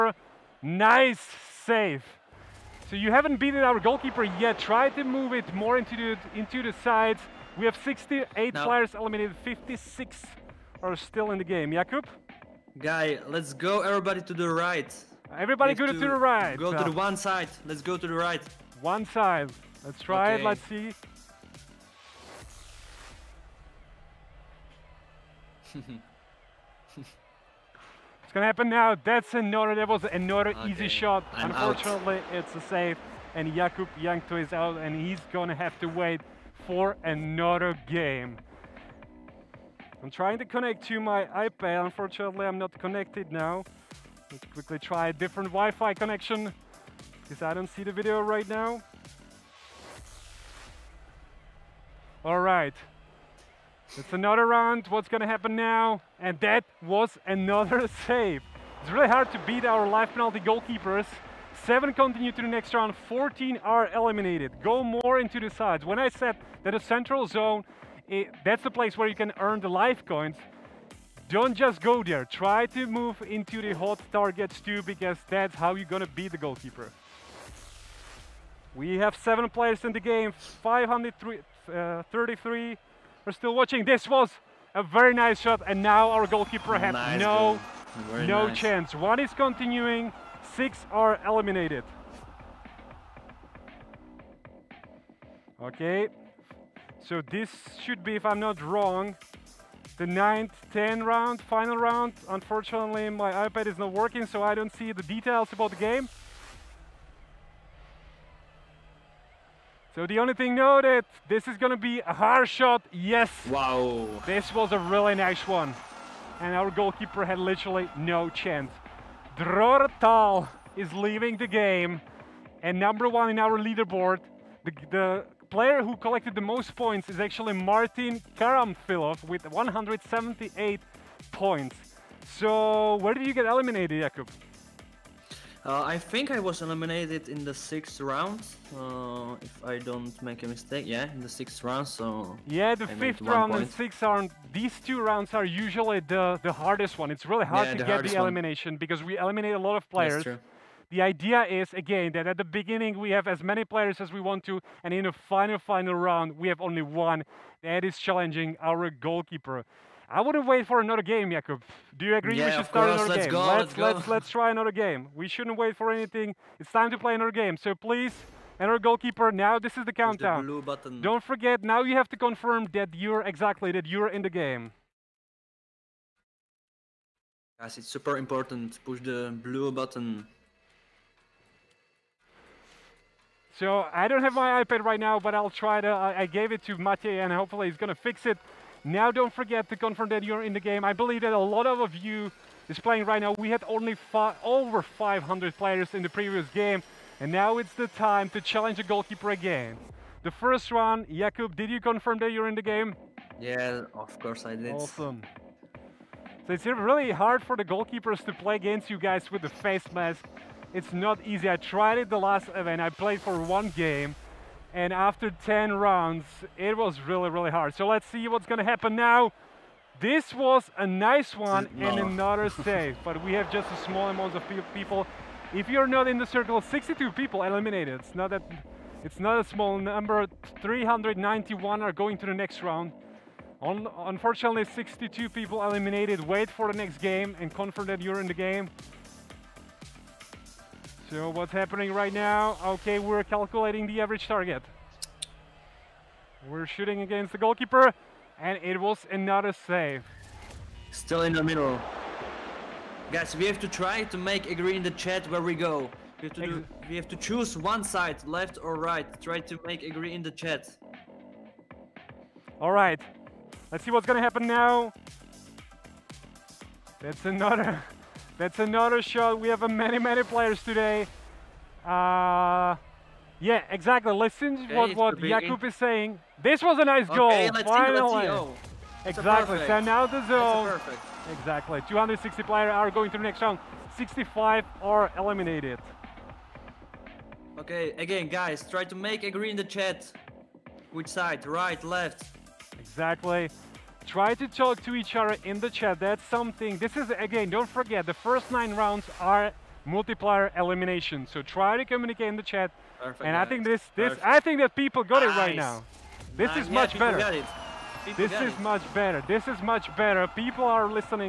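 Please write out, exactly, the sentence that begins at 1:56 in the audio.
And our goalkeeper had literally no chance.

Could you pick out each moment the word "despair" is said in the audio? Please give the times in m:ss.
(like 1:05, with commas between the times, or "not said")
not said.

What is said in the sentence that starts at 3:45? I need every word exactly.
If you're not in the circle, 62 people eliminated.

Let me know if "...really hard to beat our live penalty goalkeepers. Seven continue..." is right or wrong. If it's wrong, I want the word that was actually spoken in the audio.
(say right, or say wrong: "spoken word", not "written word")
right.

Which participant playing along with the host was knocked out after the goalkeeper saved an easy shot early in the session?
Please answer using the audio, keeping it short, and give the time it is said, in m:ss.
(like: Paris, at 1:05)
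Jakub Jankto, at 0:33.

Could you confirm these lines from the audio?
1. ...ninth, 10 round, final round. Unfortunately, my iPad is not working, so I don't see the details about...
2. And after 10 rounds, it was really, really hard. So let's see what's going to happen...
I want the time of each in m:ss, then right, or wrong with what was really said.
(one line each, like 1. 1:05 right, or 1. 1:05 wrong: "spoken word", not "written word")
1. 1:40 right
2. 3:34 right.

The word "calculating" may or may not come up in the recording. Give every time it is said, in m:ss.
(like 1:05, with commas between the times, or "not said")
4:03.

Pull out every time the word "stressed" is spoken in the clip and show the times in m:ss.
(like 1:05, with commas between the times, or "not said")
not said.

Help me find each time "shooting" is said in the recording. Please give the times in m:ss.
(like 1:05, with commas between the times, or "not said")
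4:06.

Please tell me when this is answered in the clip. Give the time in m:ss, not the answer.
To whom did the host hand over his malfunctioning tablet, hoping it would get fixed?
3:06.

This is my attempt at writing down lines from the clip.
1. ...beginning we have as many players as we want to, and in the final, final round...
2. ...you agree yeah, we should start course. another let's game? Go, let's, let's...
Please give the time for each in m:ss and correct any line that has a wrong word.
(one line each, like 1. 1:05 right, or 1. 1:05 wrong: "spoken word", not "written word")
1. 2:32 right
2. 2:42 right.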